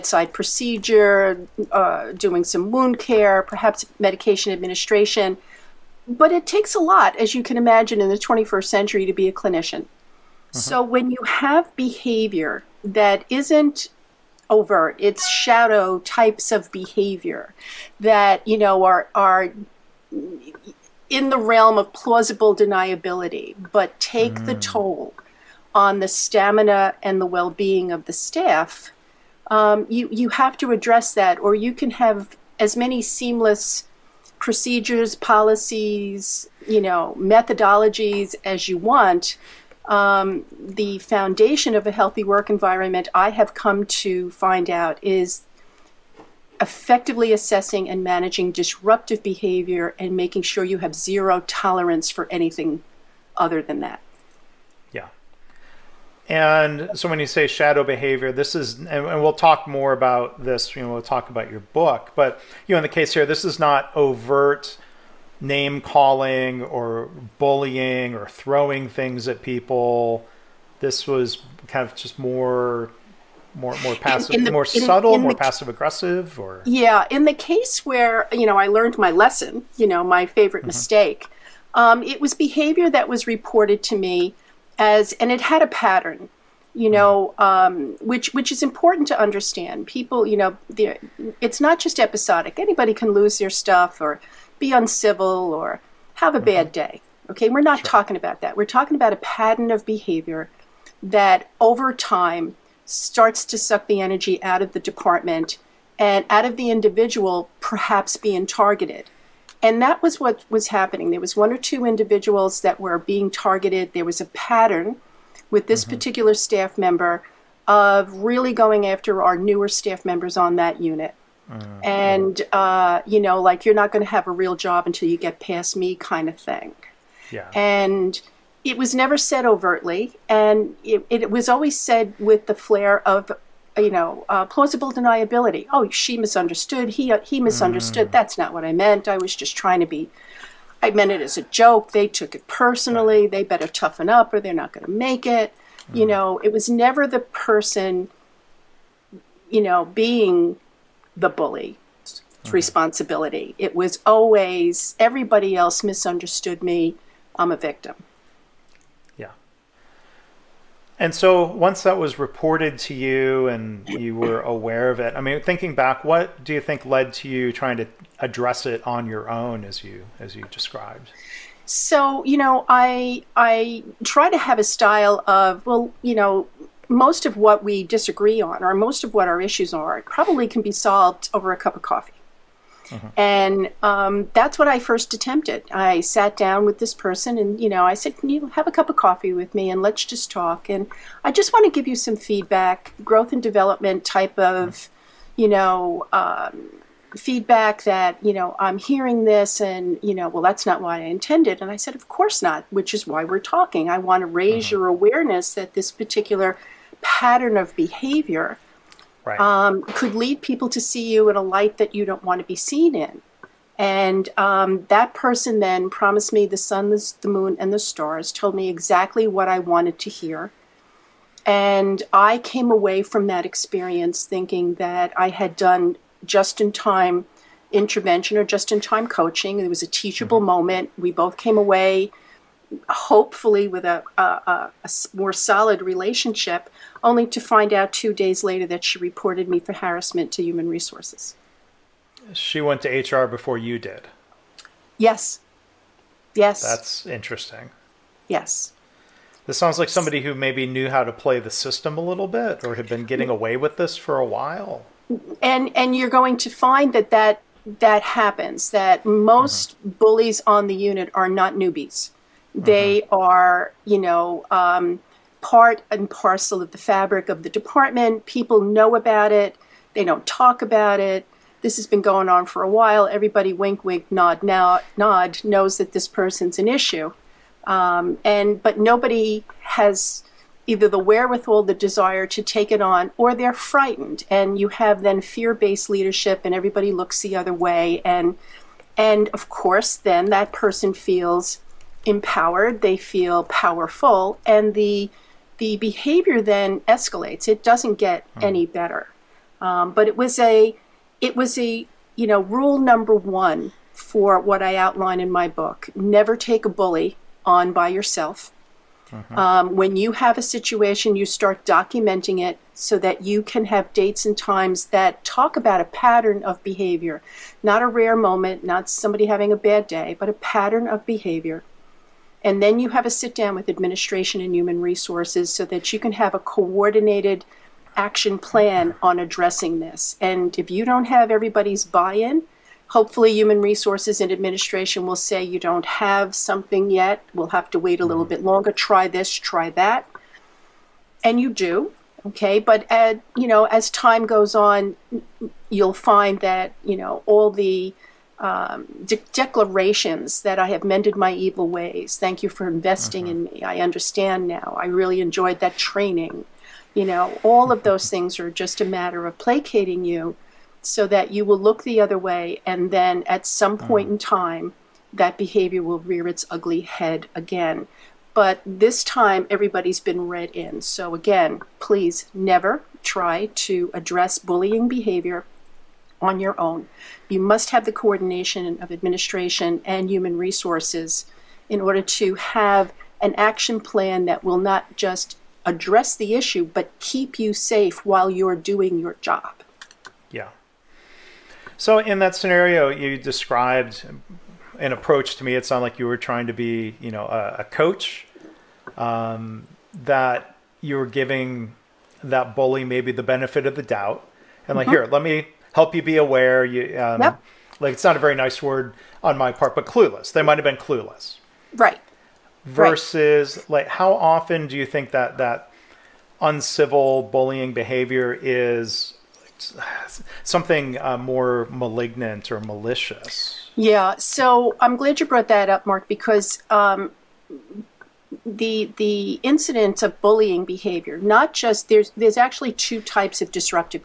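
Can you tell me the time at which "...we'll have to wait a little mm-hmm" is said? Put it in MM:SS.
05:37.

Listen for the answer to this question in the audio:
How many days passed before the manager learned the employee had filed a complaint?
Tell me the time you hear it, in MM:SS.
03:57.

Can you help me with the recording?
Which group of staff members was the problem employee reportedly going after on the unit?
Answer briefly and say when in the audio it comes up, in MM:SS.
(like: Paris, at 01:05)
Newer staff members, at 01:59.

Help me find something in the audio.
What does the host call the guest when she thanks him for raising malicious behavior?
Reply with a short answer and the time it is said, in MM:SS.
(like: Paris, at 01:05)
Mark, at 07:05.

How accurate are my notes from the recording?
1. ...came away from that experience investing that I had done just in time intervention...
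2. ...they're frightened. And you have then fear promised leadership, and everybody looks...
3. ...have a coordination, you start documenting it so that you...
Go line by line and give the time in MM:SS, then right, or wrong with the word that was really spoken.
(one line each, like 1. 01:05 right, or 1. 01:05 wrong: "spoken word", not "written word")
1. 03:42 wrong: "thinking", not "investing"
2. 04:43 wrong: "based", not "promised"
3. 05:10 wrong: "situation", not "coordination".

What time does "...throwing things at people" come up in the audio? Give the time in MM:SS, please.
01:08.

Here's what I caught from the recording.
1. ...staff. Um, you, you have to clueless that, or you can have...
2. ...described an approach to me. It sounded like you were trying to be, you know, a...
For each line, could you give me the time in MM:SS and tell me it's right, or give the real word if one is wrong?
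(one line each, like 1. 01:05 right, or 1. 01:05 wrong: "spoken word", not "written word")
1. 00:28 wrong: "address", not "clueless"
2. 06:33 right.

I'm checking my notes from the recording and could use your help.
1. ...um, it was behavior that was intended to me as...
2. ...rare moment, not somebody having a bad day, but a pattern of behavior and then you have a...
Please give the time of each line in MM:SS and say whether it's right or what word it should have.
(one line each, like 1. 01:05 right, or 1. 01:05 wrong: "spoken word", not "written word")
1. 01:21 wrong: "reported", not "intended"
2. 05:17 right.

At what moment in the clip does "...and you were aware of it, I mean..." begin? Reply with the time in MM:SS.
02:43.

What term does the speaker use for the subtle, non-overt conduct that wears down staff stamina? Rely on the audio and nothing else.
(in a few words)
Shadow behavior.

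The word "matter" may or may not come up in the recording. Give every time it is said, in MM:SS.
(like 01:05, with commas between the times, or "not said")
05:58.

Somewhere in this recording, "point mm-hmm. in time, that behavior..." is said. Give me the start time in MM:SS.
06:03.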